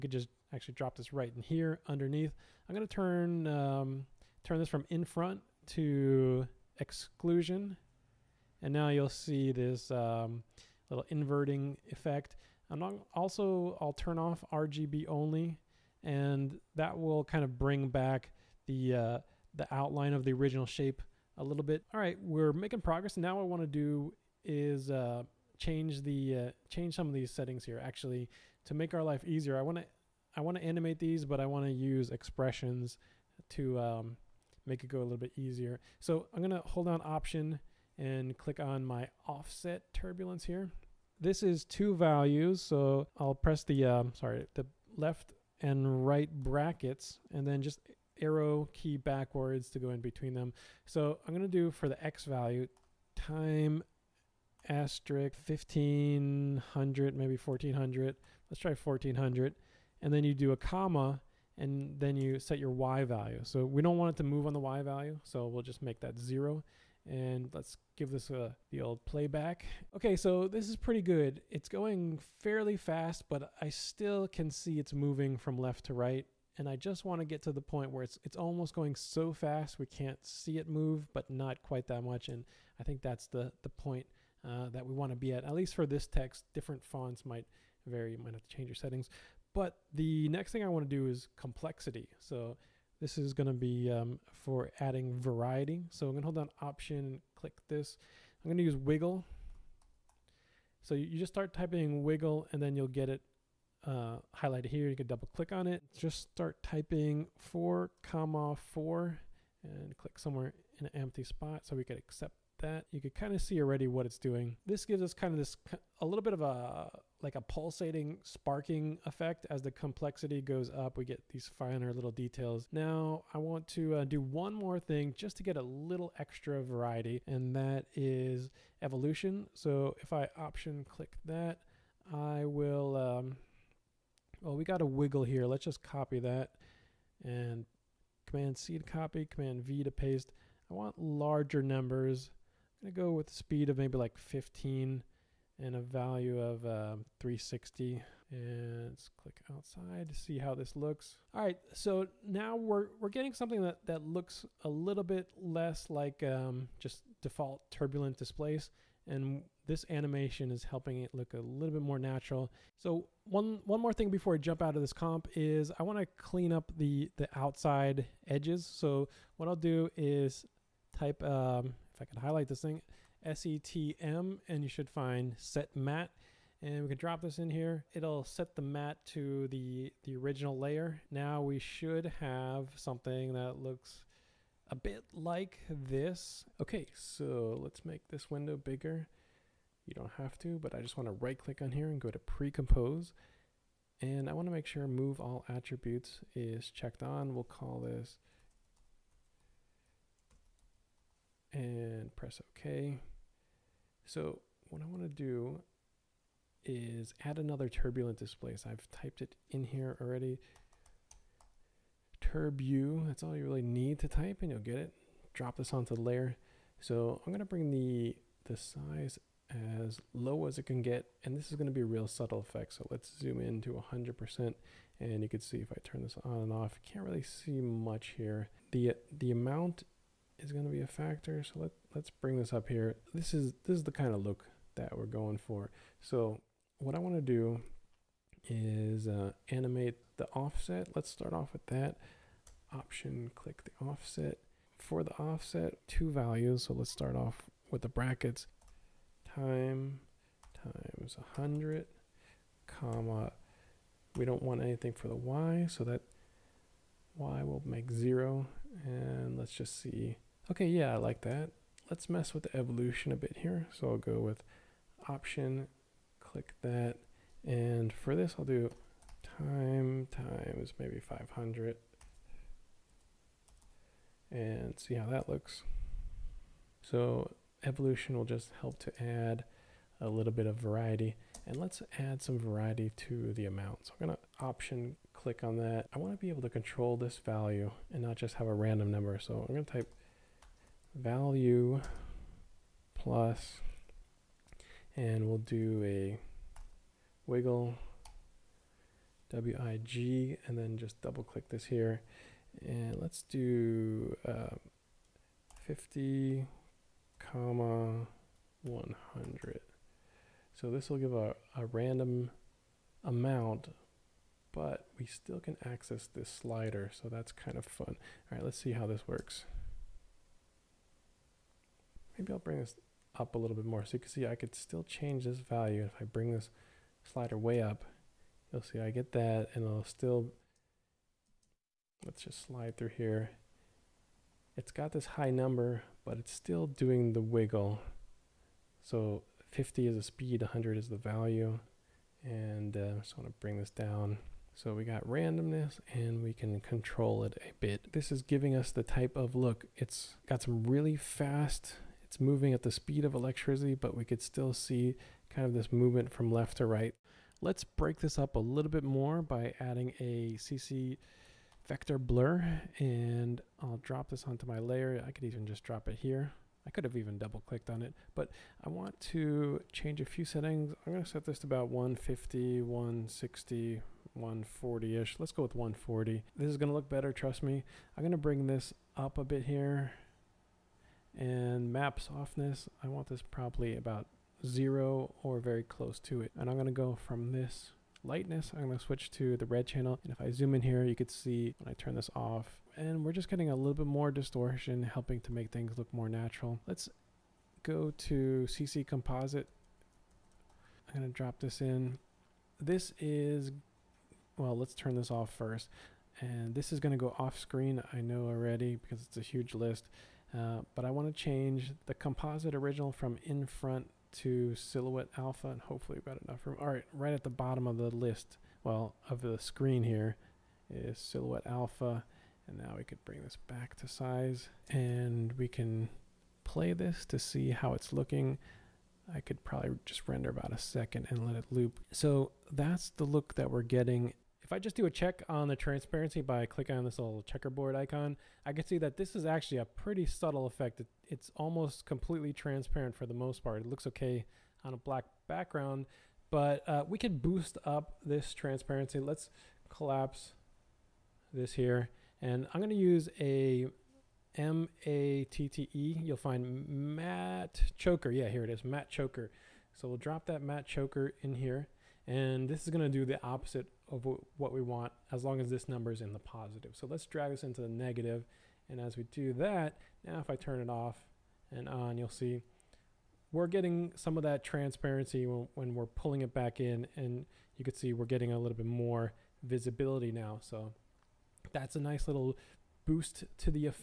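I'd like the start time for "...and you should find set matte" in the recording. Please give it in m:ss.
2:54.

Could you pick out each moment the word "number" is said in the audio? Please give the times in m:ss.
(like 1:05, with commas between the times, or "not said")
2:21, 4:48, 5:35, 7:45.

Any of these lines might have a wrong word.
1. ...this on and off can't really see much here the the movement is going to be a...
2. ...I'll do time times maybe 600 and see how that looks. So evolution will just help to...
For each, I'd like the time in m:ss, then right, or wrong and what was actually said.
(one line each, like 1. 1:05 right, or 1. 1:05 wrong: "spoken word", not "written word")
1. 3:46 wrong: "amount", not "movement"
2. 4:28 wrong: "500", not "600".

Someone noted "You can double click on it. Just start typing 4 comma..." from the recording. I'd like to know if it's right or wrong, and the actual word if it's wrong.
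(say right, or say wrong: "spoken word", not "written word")
right.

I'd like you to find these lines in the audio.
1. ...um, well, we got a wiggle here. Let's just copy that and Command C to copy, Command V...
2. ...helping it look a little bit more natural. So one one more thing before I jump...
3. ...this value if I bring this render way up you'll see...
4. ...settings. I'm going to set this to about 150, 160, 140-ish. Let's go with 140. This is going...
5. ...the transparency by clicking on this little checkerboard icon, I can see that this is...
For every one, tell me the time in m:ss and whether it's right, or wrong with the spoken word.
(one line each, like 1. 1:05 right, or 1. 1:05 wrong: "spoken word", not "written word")
1. 2:12 right
2. 2:40 right
3. 5:25 wrong: "slider", not "render"
4. 6:10 right
5. 7:15 right.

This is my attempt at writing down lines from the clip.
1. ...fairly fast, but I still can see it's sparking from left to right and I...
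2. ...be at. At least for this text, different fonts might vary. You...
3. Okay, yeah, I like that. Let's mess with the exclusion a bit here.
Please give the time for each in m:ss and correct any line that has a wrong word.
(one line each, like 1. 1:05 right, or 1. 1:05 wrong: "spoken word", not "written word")
1. 1:12 wrong: "moving", not "sparking"
2. 1:25 right
3. 4:20 wrong: "evolution", not "exclusion".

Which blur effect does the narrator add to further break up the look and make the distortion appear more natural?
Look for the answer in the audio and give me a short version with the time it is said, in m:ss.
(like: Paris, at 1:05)
CC Vector Blur, at 6:00.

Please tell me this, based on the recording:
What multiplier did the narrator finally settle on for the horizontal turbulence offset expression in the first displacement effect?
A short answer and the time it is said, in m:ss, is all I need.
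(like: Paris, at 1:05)
1400, at 0:58.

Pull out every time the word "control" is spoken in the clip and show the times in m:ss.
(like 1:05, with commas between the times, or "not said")
4:46, 5:46.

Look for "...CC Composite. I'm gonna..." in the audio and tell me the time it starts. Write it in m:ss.
6:38.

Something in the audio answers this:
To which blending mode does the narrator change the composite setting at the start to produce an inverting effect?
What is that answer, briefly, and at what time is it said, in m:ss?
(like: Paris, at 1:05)
exclusion, at 0:06.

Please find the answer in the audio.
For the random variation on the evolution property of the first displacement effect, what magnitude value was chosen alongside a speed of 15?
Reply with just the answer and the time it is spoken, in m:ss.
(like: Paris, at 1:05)
360, at 2:27.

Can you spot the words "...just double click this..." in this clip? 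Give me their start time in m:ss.
5:00.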